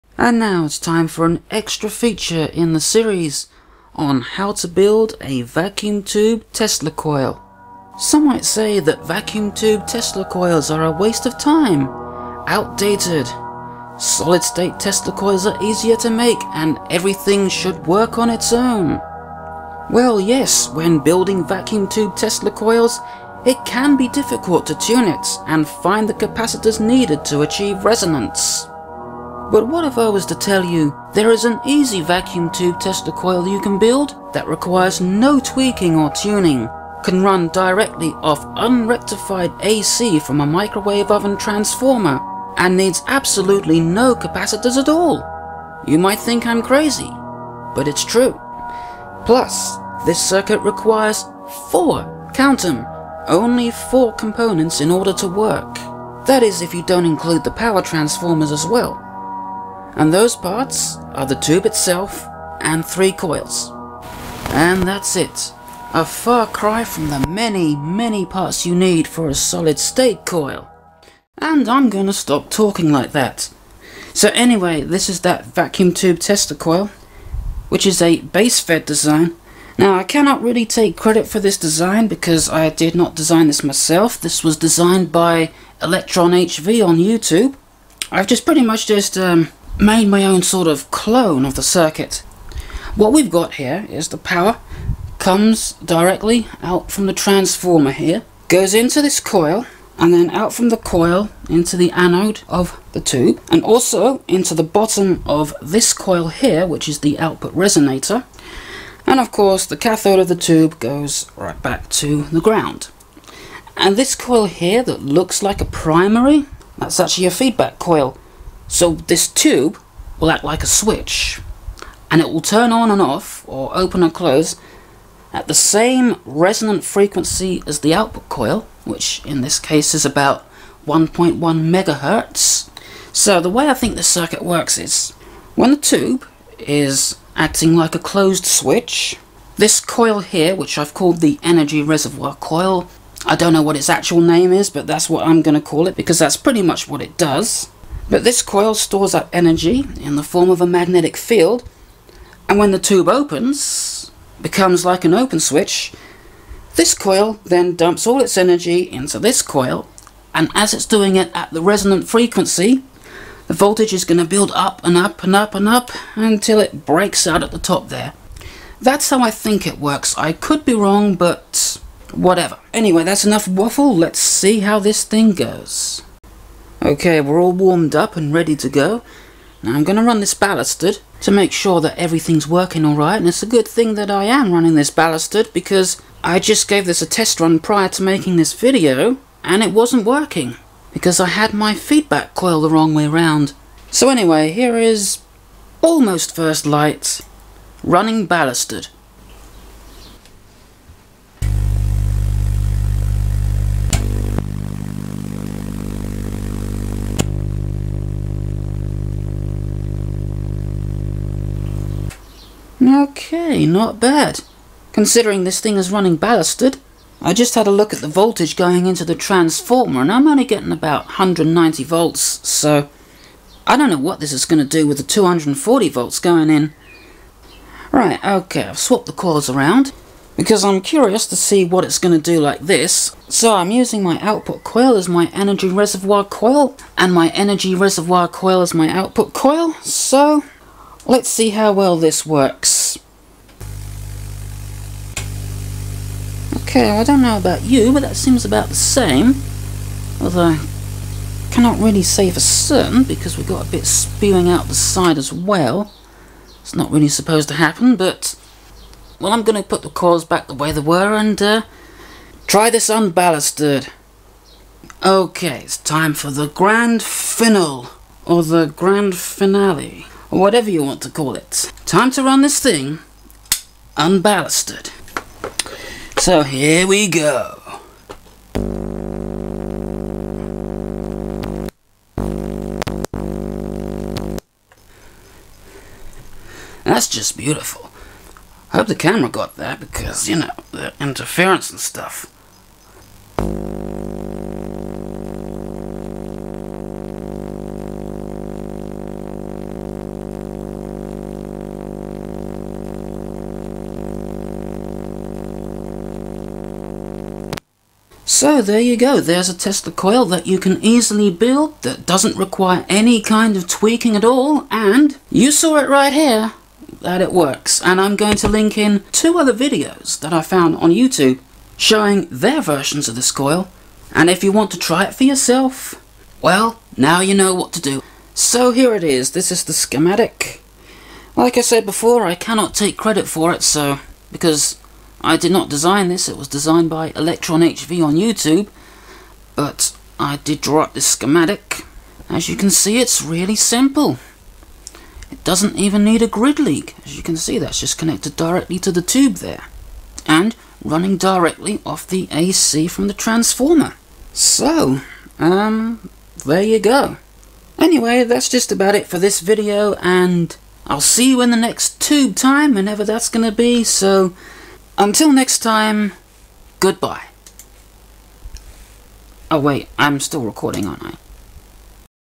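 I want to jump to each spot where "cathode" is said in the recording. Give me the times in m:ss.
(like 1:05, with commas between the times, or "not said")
1:49.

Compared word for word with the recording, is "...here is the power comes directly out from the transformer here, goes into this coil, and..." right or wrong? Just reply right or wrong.
right.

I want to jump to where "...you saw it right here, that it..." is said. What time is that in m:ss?
5:15.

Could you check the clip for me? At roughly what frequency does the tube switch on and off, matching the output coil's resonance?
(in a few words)
1.1 megahertz.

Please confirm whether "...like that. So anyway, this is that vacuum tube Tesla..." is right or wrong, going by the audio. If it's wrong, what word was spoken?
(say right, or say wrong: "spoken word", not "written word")
right.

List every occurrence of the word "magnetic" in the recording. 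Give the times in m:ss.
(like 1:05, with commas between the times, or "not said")
2:30.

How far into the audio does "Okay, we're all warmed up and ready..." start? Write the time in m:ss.
2:56.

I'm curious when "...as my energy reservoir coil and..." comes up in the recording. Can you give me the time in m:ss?
3:54.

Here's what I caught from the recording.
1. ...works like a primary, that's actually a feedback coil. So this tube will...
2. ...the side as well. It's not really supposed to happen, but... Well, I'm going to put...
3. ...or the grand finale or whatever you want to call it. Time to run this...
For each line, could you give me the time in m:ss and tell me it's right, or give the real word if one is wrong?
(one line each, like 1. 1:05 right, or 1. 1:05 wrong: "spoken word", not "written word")
1. 1:55 wrong: "looks", not "works"
2. 4:14 right
3. 4:28 right.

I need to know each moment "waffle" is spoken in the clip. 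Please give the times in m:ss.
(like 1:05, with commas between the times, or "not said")
2:53.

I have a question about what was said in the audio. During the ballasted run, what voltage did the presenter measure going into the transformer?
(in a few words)
190 volts.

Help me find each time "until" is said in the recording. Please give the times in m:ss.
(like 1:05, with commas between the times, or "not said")
2:46, 6:05.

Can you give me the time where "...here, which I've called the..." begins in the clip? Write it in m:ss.
2:20.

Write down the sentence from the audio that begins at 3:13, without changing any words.
So anyway, here is almost first light running ballasted.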